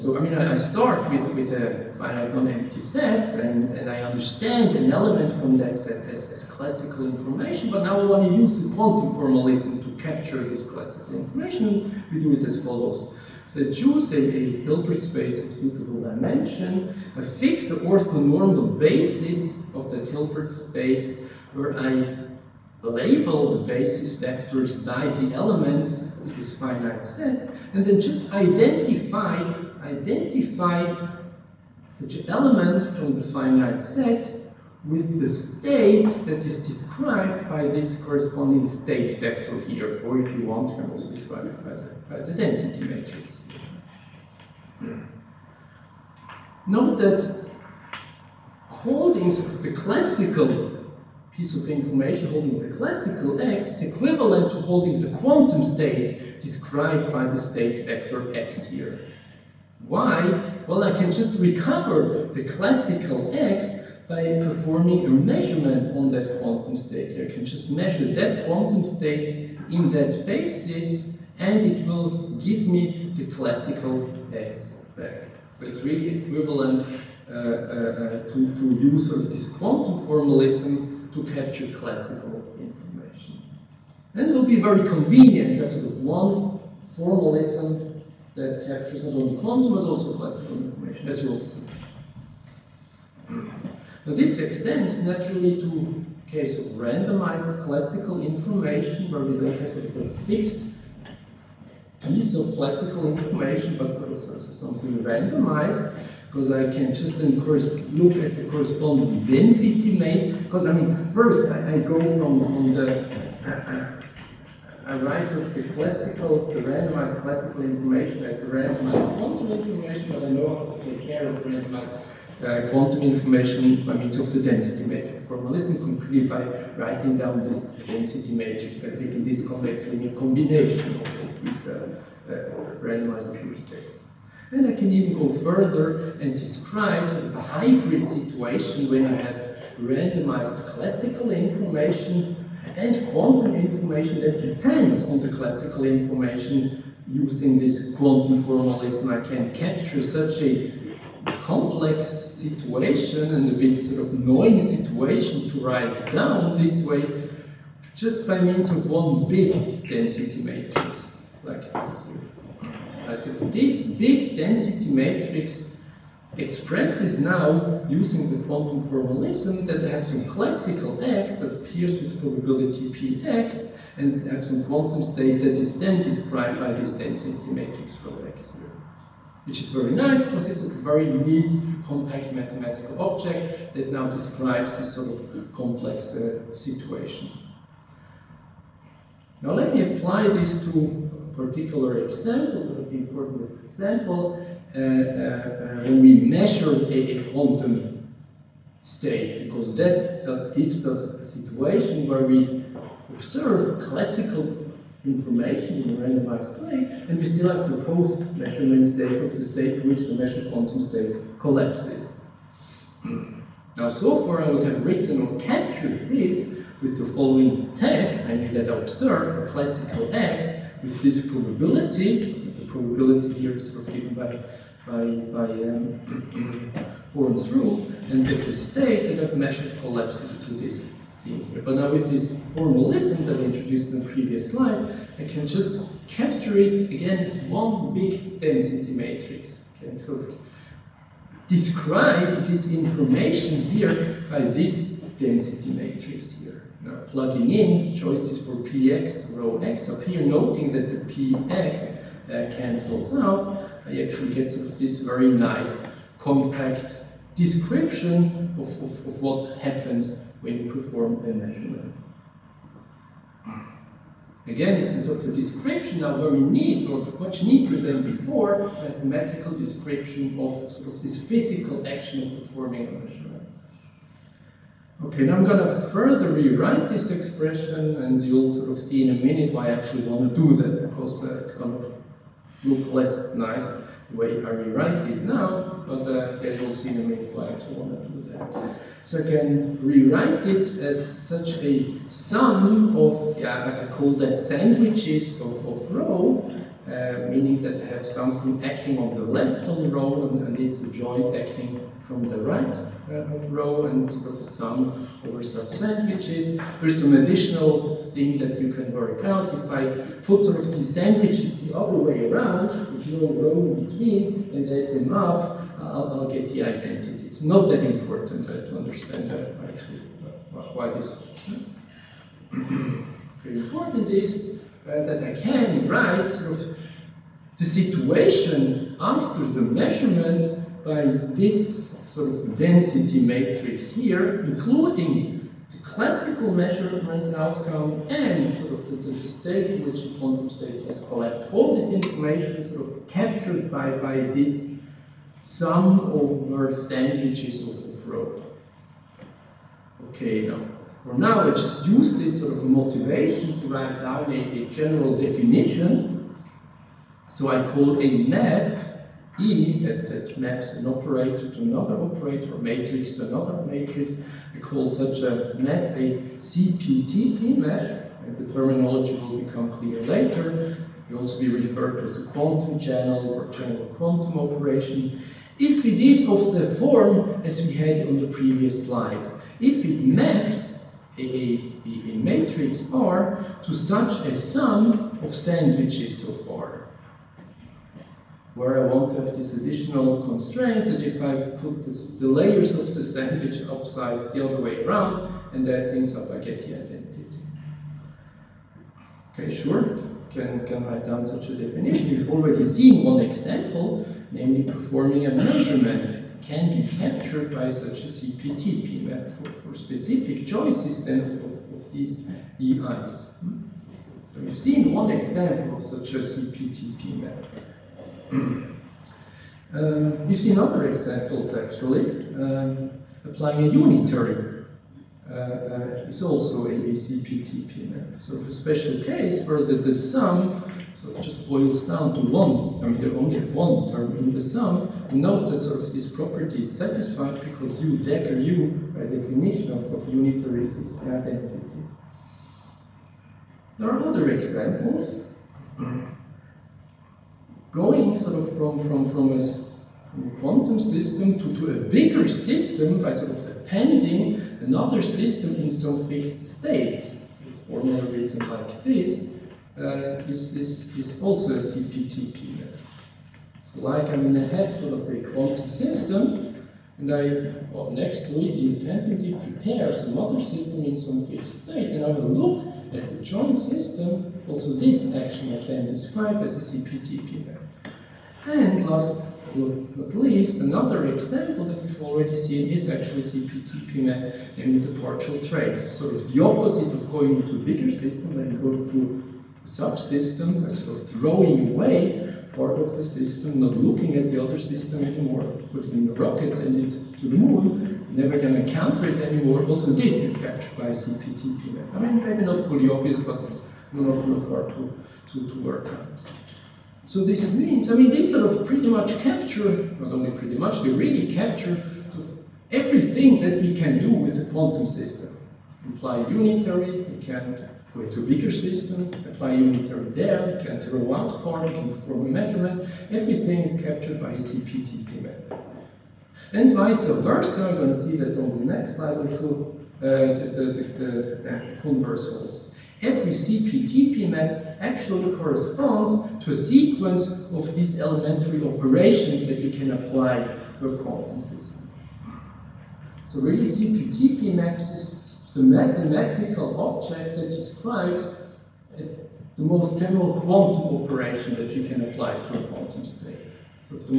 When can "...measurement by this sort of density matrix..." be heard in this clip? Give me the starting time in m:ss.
5:29.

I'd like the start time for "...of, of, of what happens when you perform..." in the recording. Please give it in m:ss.
4:18.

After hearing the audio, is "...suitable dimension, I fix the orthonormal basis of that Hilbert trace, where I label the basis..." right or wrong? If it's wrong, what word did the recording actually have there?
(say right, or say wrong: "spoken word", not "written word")
wrong: "space", not "trace".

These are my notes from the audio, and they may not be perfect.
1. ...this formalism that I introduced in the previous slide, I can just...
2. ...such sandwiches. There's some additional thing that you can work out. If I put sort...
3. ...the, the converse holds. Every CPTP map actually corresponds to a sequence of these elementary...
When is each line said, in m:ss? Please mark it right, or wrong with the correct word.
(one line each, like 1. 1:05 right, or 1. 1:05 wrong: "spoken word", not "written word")
1. 3:52 right
2. 5:05 right
3. 8:50 right.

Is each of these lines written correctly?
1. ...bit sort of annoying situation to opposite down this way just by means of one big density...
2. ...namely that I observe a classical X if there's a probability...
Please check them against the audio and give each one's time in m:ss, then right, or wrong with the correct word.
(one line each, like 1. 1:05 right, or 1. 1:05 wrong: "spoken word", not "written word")
1. 2:33 wrong: "write", not "opposite"
2. 3:38 right.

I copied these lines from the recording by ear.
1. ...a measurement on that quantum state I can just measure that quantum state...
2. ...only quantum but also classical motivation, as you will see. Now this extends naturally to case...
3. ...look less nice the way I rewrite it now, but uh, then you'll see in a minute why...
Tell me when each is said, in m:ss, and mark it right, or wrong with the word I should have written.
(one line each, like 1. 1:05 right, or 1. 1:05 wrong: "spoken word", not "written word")
1. 1:05 right
2. 1:29 wrong: "information", not "motivation"
3. 4:42 right.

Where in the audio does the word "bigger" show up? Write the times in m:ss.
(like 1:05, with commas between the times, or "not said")
7:31, 8:07, 8:38.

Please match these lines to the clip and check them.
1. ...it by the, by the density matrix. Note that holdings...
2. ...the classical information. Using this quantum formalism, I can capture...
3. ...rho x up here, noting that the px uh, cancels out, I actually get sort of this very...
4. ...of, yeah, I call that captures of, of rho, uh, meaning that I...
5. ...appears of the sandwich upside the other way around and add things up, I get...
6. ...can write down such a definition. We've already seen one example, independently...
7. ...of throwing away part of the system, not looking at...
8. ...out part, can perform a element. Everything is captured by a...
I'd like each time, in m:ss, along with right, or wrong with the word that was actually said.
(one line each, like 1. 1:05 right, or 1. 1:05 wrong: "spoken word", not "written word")
1. 0:41 right
2. 2:25 right
3. 4:09 right
4. 4:52 wrong: "sandwiches", not "captures"
5. 6:32 wrong: "layers", not "appears"
6. 6:40 wrong: "namely", not "independently"
7. 8:10 right
8. 8:41 wrong: "measurement", not "element".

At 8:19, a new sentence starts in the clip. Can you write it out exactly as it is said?
Also, this is captured by CPTP.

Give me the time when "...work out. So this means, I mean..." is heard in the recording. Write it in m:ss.
8:25.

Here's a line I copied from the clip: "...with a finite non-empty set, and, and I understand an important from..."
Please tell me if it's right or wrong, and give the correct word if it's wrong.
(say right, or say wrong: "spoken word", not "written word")
wrong: "element", not "important".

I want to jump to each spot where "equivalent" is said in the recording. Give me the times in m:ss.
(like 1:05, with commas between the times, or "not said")
0:53, 1:16.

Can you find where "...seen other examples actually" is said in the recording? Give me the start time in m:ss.
7:00.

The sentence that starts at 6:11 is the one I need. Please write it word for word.
It will also be referred to as a quantum channel or general quantum operation.